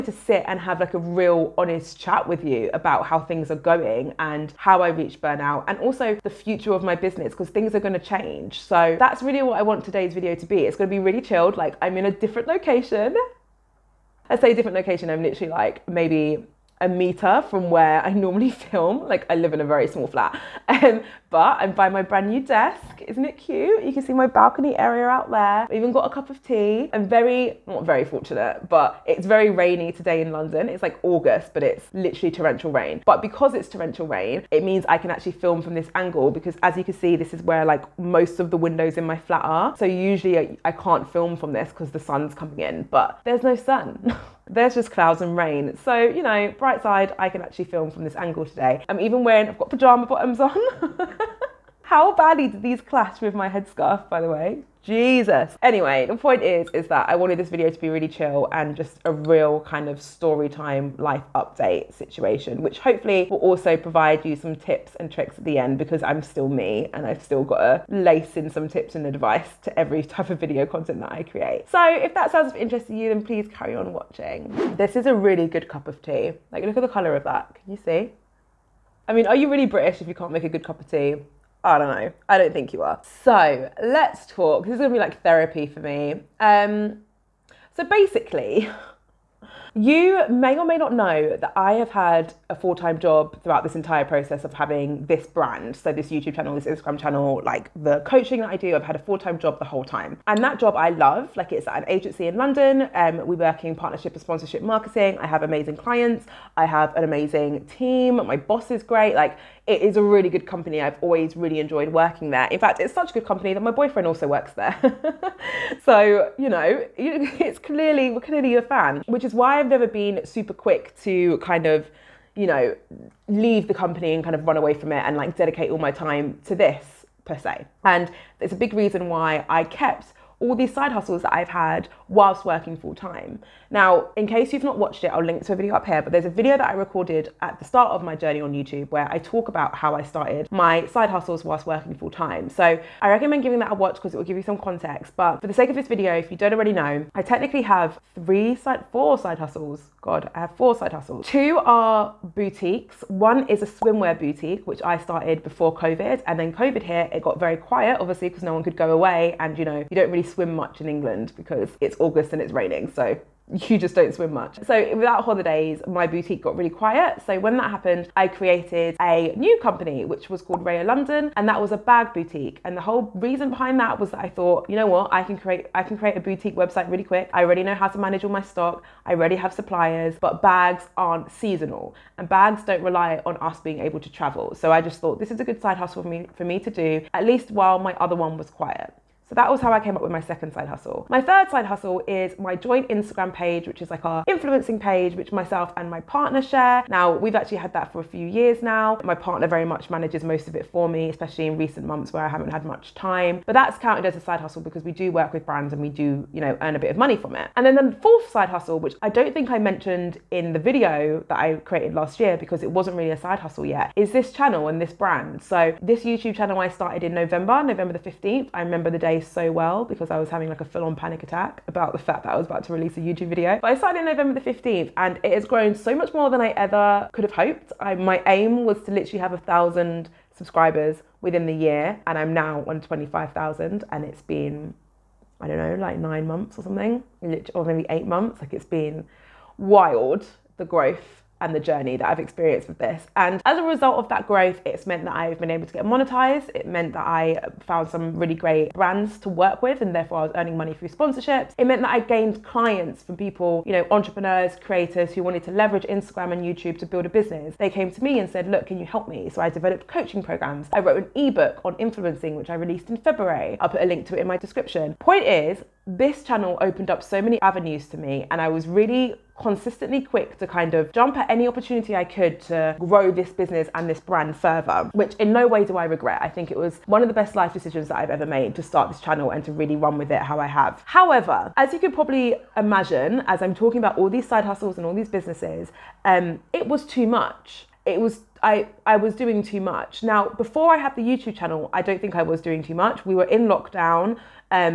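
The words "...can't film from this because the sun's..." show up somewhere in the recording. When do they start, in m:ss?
0:40.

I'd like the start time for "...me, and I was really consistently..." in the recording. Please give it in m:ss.
4:27.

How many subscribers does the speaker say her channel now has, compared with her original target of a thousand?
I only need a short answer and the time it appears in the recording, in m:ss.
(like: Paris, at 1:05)
25,000, at 3:52.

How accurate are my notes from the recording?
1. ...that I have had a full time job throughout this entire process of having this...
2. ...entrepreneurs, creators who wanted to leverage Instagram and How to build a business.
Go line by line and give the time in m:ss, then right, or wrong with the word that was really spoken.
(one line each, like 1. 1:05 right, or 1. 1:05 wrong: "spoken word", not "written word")
1. 1:31 right
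2. 4:13 wrong: "YouTube", not "How".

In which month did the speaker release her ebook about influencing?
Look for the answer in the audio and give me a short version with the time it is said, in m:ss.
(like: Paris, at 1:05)
February, at 4:22.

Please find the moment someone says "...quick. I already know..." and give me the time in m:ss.
2:57.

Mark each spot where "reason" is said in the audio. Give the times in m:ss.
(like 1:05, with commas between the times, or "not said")
2:08, 2:53.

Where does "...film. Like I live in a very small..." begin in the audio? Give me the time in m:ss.
0:18.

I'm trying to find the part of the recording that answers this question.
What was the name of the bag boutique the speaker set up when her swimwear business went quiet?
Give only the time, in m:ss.
2:50.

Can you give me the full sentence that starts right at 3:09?
So that was how I came up with my second side hustle.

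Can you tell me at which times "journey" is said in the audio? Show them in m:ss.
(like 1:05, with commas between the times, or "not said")
2:18, 4:01.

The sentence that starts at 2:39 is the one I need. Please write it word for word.
And, you know, you don't really swim much in England because it's August and it's raining.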